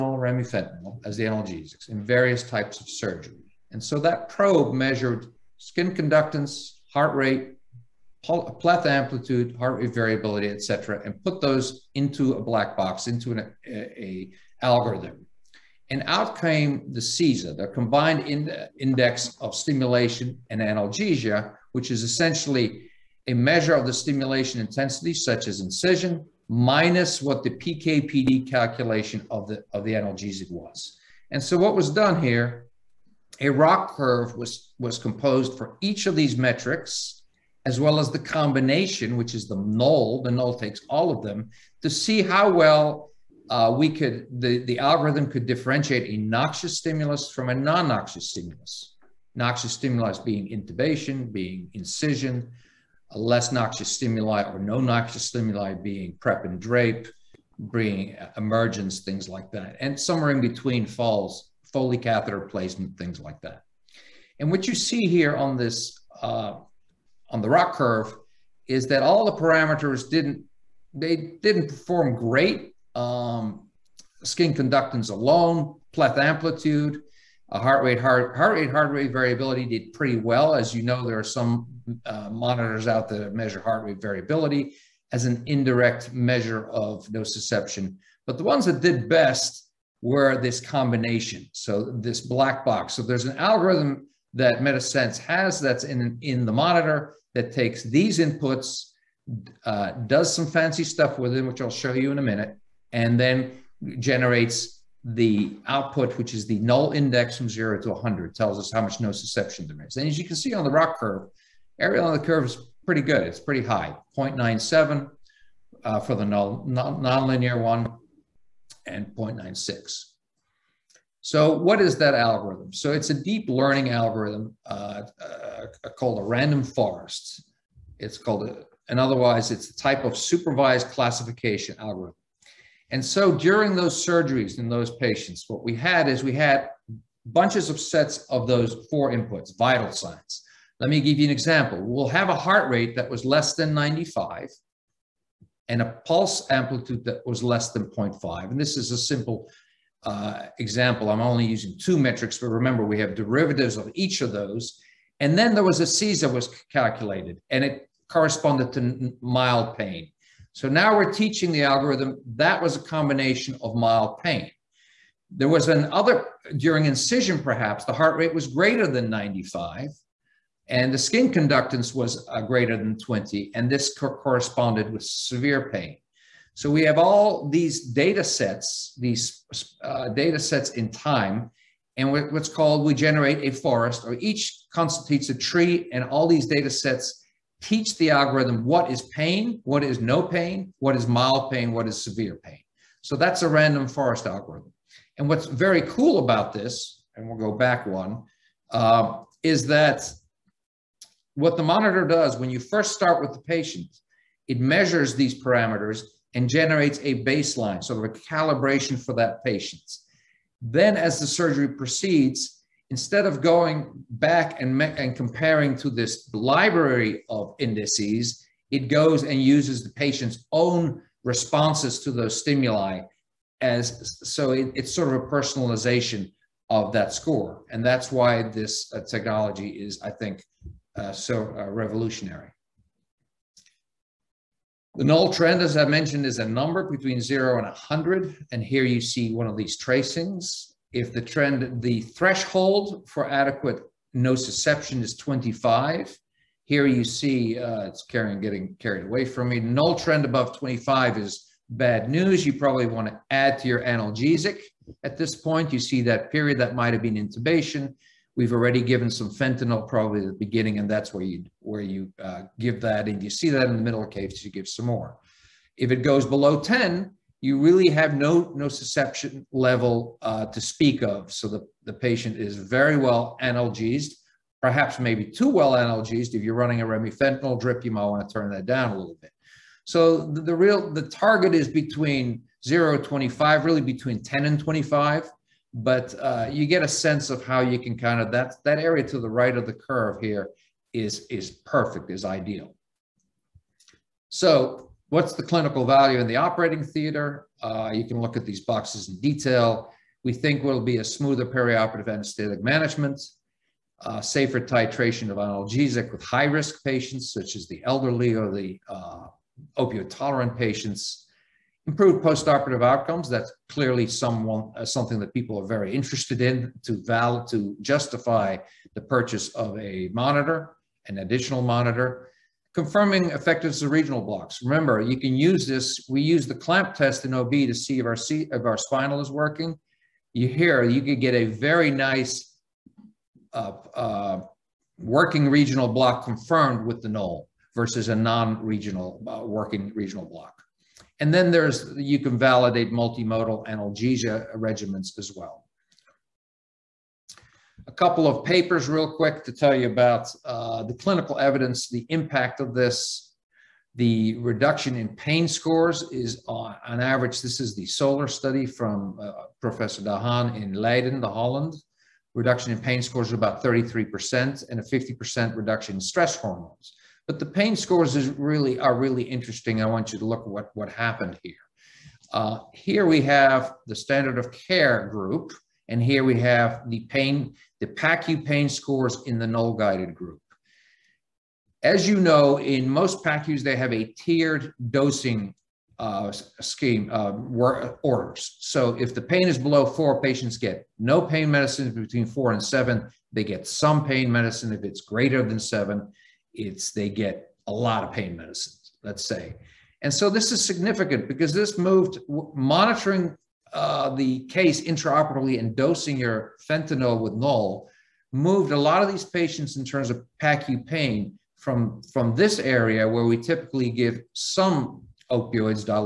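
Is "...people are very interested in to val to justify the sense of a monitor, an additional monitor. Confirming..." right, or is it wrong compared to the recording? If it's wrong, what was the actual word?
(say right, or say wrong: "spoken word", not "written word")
wrong: "purchase", not "sense".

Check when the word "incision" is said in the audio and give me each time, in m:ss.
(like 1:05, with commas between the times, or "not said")
0:25, 0:51, 2:46.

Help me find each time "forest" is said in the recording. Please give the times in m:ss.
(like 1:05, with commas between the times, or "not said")
2:06, 3:03, 3:13.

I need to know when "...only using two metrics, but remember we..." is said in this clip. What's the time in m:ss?
2:31.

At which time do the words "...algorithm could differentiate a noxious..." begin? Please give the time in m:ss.
0:44.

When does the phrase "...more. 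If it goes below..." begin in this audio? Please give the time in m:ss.
4:24.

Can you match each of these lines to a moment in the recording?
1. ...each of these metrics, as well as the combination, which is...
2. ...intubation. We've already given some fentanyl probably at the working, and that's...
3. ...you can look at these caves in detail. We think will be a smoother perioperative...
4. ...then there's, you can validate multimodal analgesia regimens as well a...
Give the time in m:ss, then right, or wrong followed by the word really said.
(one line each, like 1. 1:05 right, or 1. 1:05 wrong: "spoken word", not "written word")
1. 0:35 right
2. 4:17 wrong: "beginning", not "working"
3. 4:57 wrong: "boxes", not "caves"
4. 5:41 right.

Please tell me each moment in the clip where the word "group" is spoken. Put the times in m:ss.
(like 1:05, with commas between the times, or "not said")
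6:15, 6:20.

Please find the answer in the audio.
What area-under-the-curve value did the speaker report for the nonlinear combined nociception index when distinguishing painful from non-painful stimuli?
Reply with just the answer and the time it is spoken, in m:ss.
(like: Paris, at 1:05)
0.97, at 1:54.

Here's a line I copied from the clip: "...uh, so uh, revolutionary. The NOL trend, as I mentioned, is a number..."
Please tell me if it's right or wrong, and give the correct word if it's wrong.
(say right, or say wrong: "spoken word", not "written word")
right.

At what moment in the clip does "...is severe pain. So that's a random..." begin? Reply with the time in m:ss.
3:11.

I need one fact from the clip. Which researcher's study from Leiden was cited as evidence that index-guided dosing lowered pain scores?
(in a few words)
Professor Dahan.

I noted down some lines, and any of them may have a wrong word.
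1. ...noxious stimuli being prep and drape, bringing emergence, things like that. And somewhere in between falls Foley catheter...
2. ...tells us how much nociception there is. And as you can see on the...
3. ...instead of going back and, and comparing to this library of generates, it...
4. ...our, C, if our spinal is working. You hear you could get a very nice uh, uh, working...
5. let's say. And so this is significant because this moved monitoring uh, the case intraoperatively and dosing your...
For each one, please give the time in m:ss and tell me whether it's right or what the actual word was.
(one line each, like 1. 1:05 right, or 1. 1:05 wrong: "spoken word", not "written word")
1. 0:54 right
2. 1:48 right
3. 3:32 wrong: "indices", not "generates"
4. 5:28 right
5. 6:39 right.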